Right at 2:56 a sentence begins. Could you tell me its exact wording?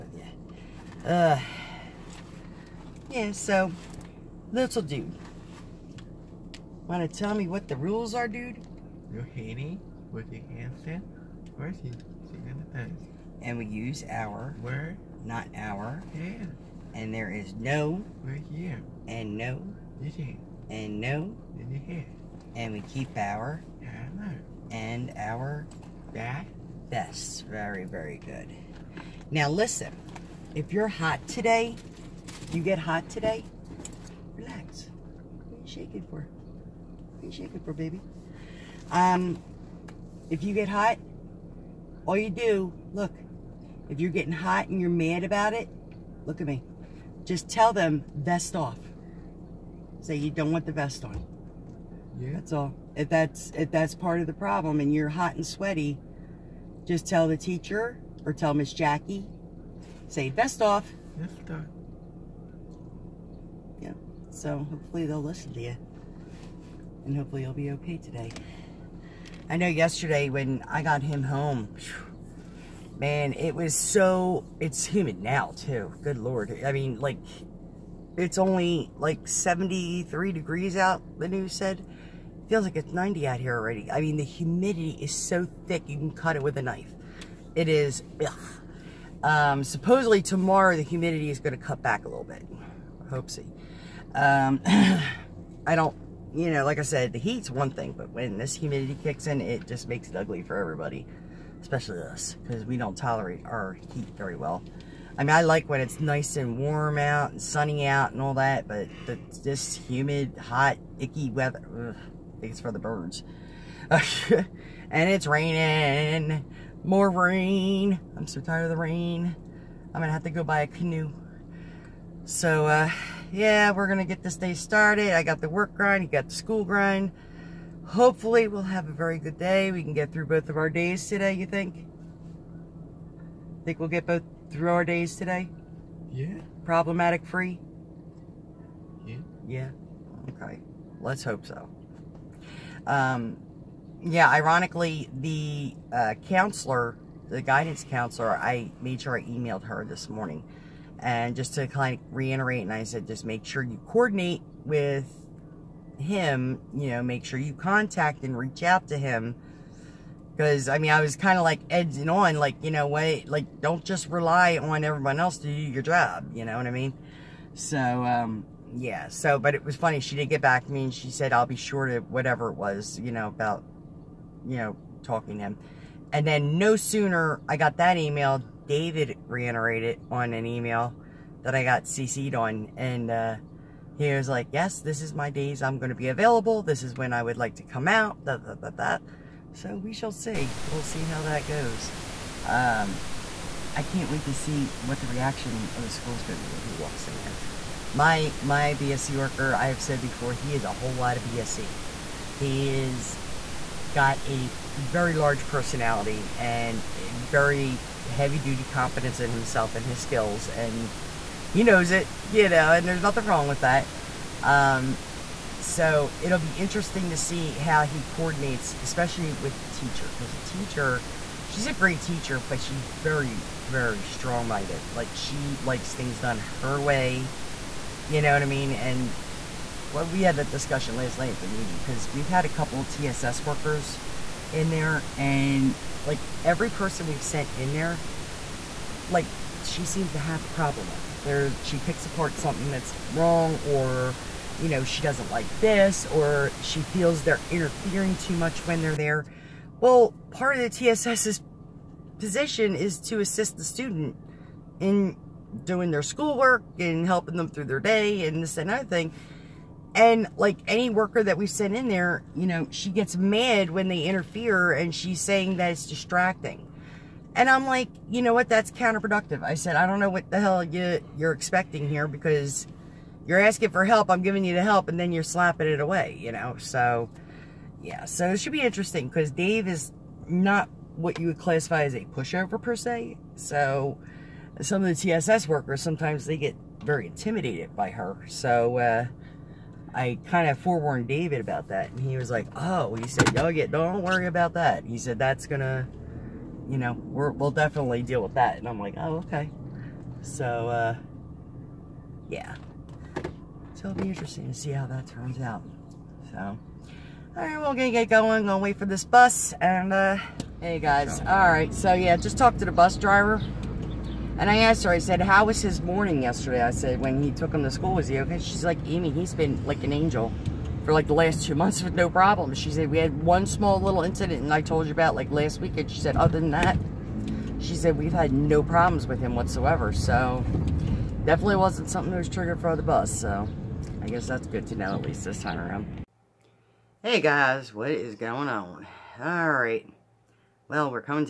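And then no sooner I got that email, David reiterated on an email that I got CC'd on.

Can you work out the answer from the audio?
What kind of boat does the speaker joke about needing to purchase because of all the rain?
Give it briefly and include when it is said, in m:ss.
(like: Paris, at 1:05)
canoe, at 2:00.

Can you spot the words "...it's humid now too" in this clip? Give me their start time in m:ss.
1:14.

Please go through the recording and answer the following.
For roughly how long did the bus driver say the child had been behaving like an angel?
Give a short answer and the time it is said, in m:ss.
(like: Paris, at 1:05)
2 months, at 5:21.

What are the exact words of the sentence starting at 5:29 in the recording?
So definitely wasn't something that was triggered for the bus.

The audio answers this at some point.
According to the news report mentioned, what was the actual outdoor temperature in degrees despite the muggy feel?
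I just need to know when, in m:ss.
1:19.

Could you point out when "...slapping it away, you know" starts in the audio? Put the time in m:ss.
4:35.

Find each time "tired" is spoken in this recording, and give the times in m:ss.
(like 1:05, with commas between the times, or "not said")
1:58.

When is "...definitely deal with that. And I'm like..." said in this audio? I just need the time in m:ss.
4:57.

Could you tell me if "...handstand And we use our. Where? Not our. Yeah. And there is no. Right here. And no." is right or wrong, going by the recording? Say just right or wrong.
right.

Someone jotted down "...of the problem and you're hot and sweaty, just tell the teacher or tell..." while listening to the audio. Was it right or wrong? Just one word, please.
right.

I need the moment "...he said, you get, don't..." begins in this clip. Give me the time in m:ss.
4:52.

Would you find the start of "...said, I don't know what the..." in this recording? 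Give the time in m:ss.
4:29.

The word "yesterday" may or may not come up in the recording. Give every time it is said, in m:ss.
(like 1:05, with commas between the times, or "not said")
1:09, 5:16.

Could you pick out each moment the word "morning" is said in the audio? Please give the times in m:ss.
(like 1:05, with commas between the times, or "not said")
2:30, 5:15.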